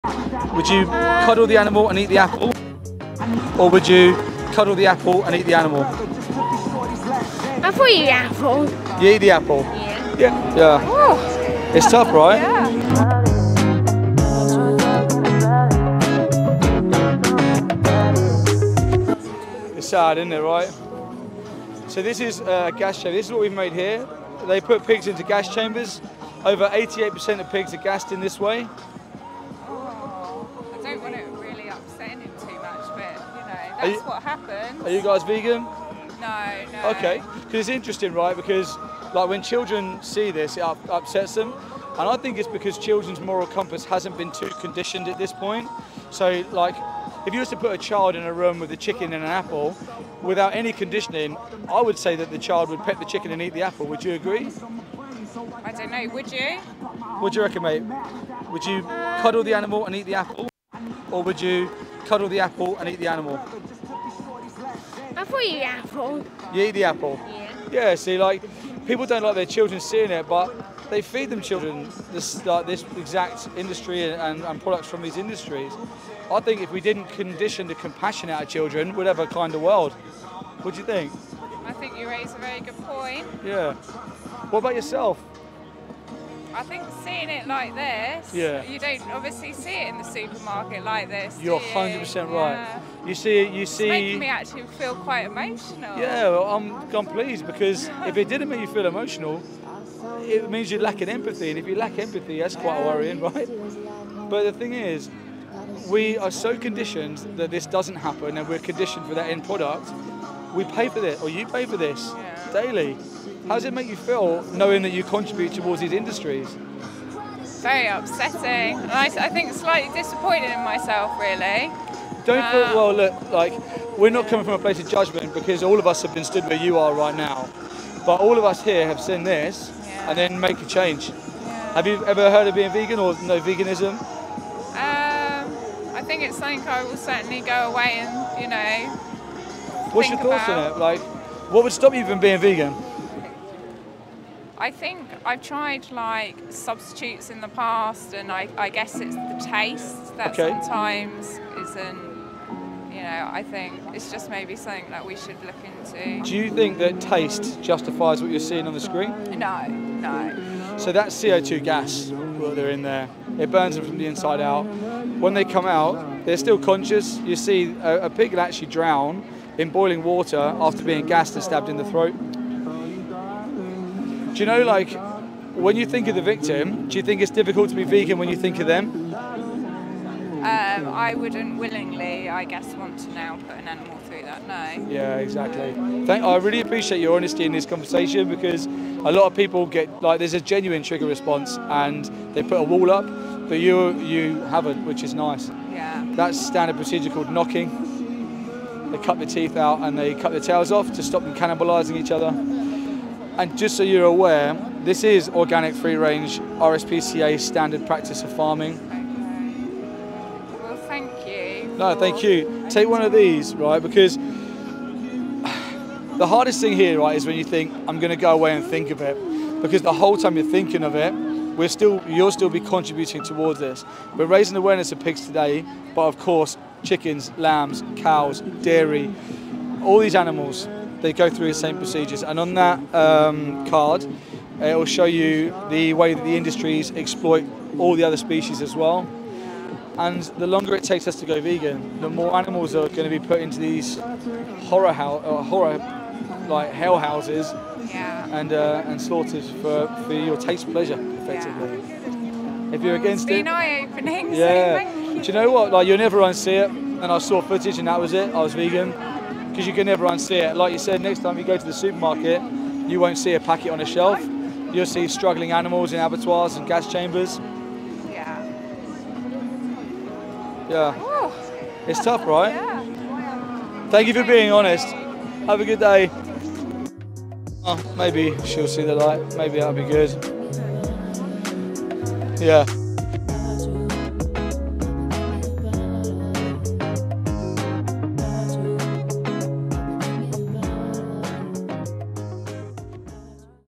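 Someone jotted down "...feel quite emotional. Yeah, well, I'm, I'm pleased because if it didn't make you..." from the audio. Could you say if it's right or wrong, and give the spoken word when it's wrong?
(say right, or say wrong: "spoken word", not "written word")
right.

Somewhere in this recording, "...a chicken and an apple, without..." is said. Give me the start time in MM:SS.
00:48.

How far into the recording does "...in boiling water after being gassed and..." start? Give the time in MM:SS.
02:49.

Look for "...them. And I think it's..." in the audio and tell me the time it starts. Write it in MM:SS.
00:41.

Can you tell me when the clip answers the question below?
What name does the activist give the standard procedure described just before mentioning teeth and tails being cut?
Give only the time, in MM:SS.
03:17.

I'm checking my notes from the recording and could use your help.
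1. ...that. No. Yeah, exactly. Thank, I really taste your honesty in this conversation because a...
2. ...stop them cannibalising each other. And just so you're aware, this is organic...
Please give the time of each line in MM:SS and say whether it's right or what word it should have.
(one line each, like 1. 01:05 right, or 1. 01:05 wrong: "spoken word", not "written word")
1. 03:04 wrong: "appreciate", not "taste"
2. 03:21 right.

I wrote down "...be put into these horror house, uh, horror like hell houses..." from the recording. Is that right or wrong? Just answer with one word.
right.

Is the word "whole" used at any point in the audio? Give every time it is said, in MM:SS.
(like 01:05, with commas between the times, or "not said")
03:39.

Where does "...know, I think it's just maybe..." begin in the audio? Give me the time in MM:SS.
02:33.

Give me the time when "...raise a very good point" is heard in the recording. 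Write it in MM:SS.
01:22.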